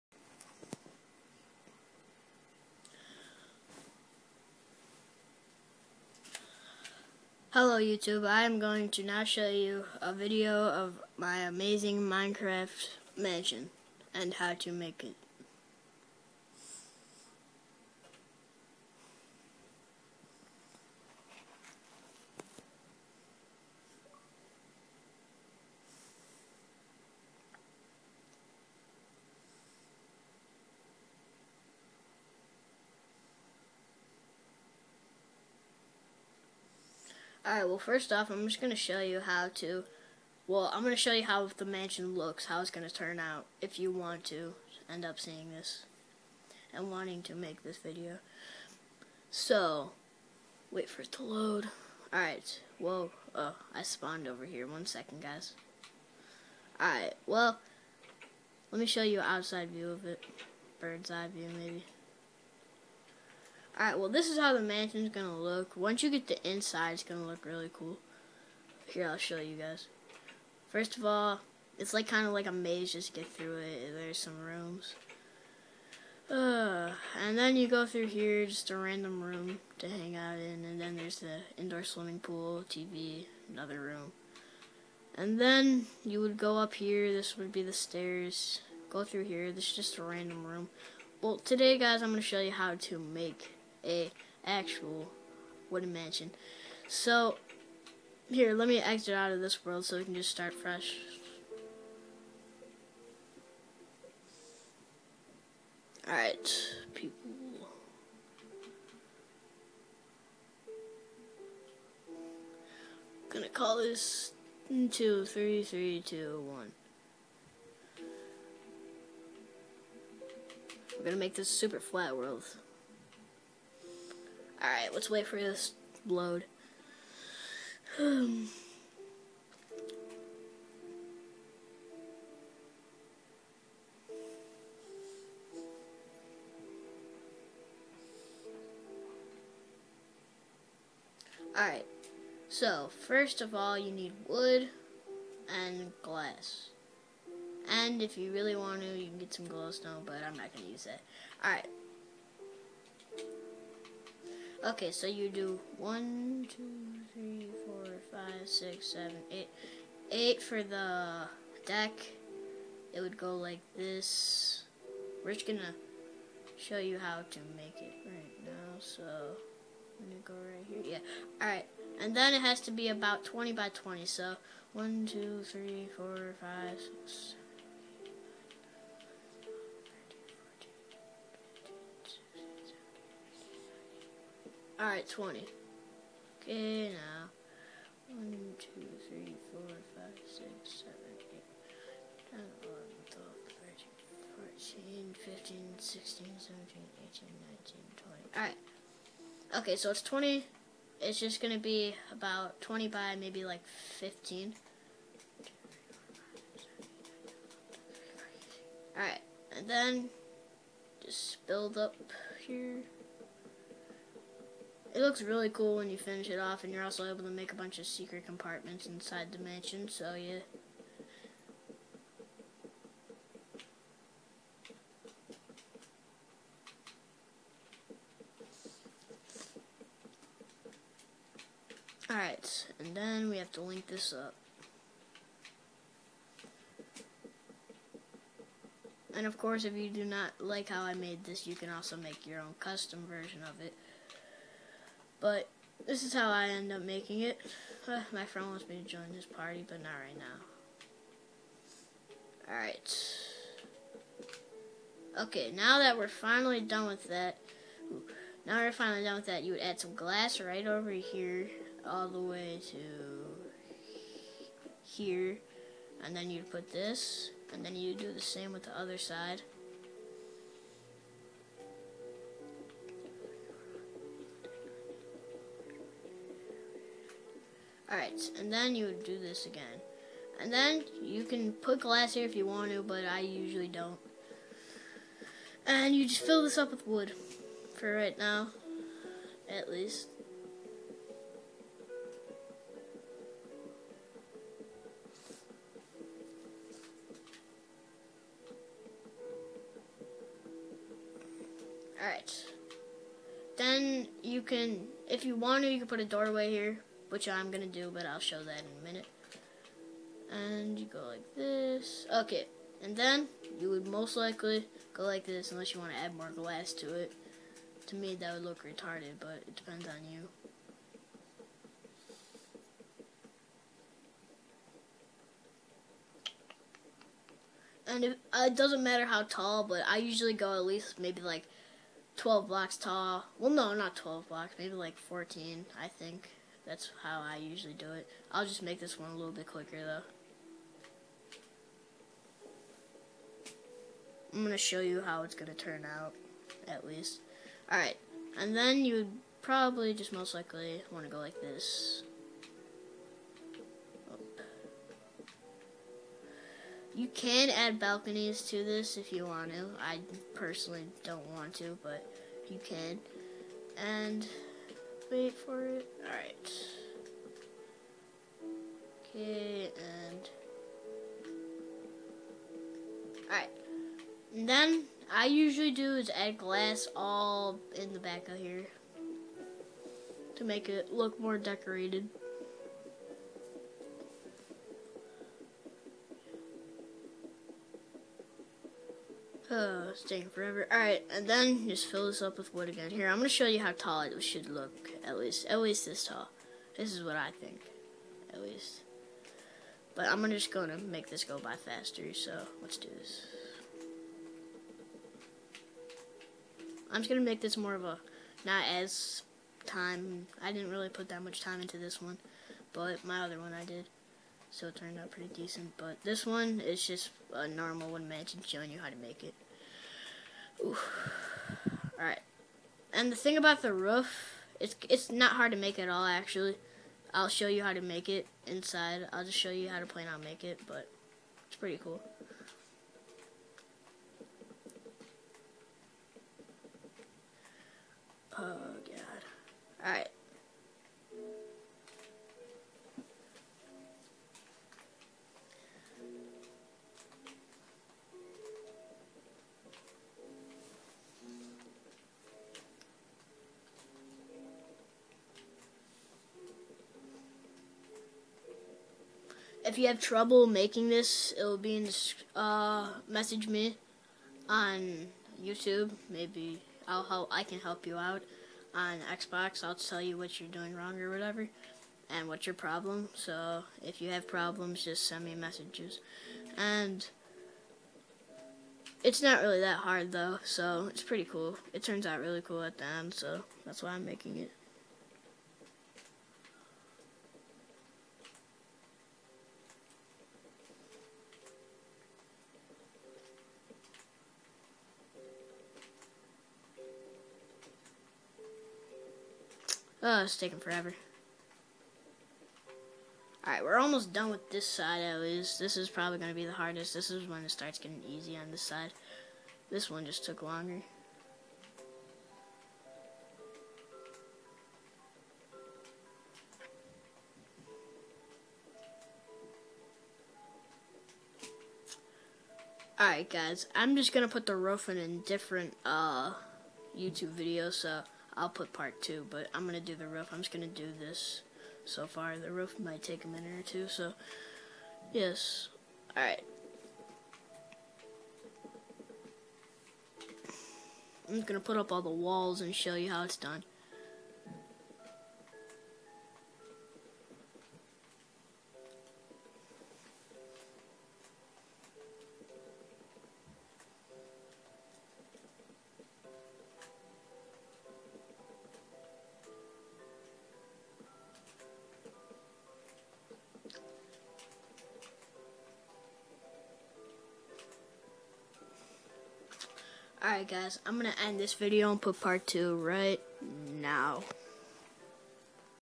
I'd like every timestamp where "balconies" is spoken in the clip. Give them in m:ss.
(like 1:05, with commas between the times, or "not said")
5:57.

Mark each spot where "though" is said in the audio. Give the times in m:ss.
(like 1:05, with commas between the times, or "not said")
5:39, 8:00.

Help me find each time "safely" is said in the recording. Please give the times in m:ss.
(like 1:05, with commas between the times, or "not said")
not said.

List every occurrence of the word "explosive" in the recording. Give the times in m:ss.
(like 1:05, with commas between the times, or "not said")
not said.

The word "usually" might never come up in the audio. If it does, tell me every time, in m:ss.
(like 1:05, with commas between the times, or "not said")
4:43, 5:29, 5:37, 6:15.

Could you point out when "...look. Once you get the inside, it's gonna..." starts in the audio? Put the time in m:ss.
1:05.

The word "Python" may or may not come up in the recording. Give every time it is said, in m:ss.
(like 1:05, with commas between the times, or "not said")
not said.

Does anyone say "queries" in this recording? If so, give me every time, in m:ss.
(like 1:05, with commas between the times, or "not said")
not said.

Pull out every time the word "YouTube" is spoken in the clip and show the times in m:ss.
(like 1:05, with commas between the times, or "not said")
0:07, 7:45, 8:46.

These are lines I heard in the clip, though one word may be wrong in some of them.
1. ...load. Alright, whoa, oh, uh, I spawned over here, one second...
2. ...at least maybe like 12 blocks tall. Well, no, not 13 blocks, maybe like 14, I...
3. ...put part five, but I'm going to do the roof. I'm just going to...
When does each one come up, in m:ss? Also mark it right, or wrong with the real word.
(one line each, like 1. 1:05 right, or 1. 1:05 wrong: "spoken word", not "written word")
1. 0:51 right
2. 5:30 wrong: "12", not "13"
3. 8:48 wrong: "two", not "five".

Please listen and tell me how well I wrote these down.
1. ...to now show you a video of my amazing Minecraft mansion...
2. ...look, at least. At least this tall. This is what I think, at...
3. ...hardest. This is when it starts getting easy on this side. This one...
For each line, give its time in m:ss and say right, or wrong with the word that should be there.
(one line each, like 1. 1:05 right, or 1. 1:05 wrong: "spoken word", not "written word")
1. 0:08 right
2. 6:34 right
3. 8:26 right.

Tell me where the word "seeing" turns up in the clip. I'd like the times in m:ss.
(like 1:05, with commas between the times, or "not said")
0:45.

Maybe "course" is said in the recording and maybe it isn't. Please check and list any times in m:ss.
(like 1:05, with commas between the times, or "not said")
3:59.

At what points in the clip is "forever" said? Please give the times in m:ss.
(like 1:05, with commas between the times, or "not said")
6:30, 8:20.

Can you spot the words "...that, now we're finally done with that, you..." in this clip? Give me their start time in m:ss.
4:17.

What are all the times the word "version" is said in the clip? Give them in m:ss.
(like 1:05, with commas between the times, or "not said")
4:03.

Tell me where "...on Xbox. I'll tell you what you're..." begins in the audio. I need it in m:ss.
7:48.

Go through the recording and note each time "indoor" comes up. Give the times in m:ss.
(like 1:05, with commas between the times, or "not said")
1:21.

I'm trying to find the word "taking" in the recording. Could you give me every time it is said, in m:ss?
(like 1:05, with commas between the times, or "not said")
6:30, 8:20.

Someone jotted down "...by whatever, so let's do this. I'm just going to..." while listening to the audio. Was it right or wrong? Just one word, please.
wrong.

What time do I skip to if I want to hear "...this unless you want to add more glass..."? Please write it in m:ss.
5:15.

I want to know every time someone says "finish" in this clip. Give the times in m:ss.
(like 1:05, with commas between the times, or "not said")
3:35.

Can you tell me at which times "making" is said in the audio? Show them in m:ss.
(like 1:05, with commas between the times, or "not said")
4:06, 7:40, 8:04.